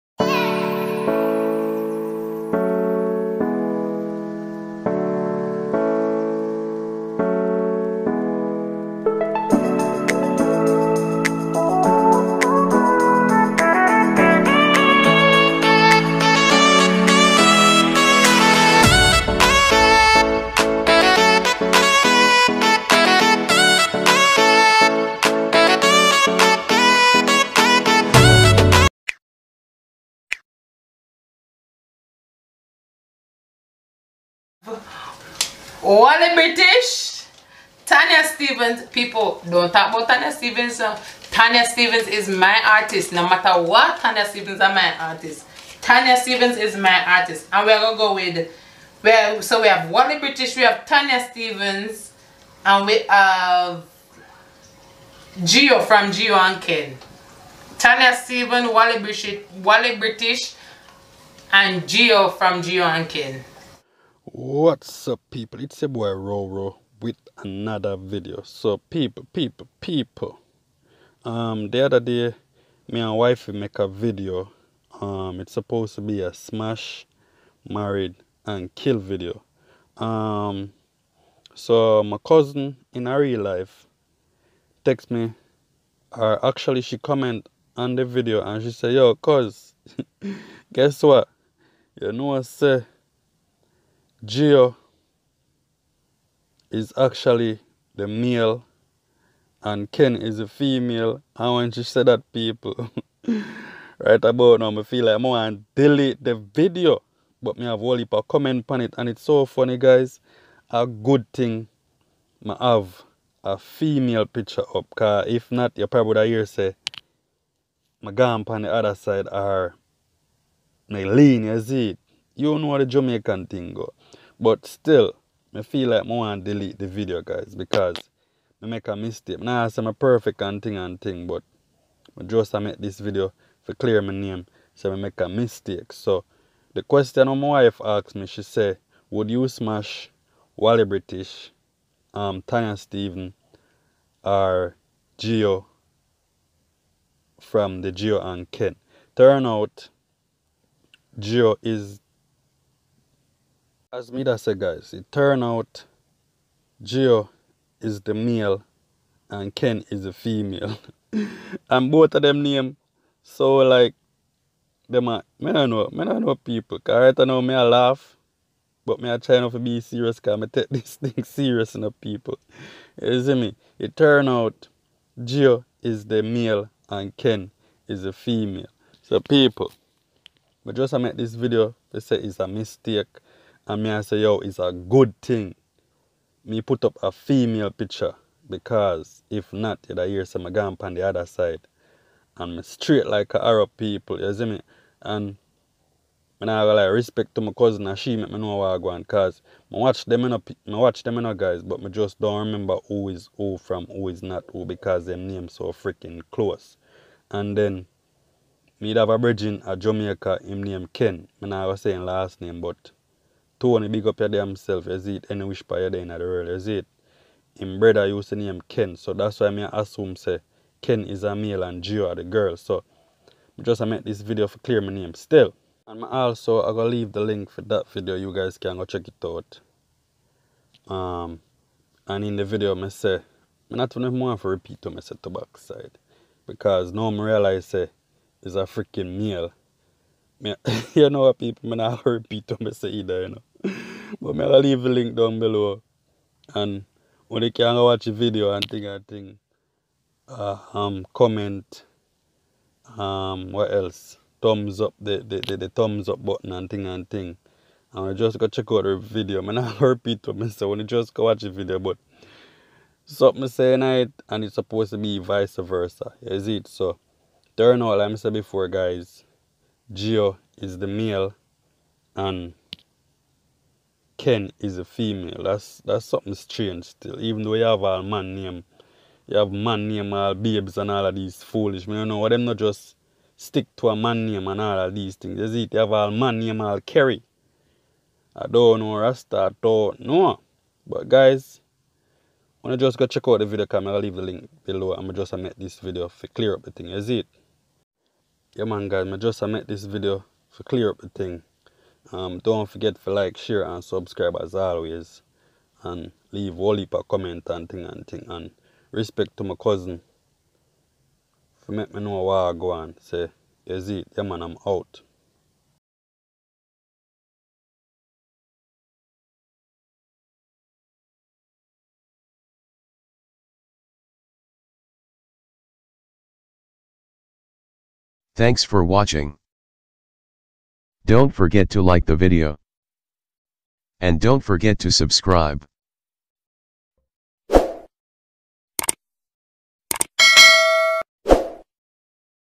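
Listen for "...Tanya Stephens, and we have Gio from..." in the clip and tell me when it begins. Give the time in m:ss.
0:50.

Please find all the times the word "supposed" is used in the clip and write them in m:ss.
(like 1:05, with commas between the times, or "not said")
1:15, 4:24.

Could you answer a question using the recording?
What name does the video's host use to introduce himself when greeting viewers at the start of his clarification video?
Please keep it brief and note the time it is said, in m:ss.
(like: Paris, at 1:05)
Roro, at 1:06.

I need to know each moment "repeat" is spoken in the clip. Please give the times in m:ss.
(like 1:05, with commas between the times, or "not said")
3:54, 4:02, 4:19.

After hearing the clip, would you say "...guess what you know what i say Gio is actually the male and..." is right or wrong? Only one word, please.
right.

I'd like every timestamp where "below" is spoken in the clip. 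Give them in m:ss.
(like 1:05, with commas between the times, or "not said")
4:05, 4:54.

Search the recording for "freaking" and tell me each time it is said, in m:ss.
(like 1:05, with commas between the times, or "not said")
3:25, 3:58.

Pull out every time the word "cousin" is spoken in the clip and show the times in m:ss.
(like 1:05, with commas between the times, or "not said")
1:22, 3:17, 5:09.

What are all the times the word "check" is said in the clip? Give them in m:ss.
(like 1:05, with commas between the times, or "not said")
3:48, 4:18, 4:53.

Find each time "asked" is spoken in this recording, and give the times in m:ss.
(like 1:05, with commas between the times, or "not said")
2:17.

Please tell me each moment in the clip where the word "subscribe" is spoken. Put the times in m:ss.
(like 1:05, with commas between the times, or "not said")
5:03, 5:34.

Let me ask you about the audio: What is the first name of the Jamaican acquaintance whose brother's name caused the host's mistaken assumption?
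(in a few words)
Tony.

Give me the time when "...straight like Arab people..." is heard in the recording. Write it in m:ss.
3:12.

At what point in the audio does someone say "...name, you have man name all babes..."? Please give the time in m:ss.
4:38.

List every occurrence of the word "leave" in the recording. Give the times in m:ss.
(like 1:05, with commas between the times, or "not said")
3:46, 4:04, 4:53, 5:06.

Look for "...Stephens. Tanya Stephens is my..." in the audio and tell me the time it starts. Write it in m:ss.
0:40.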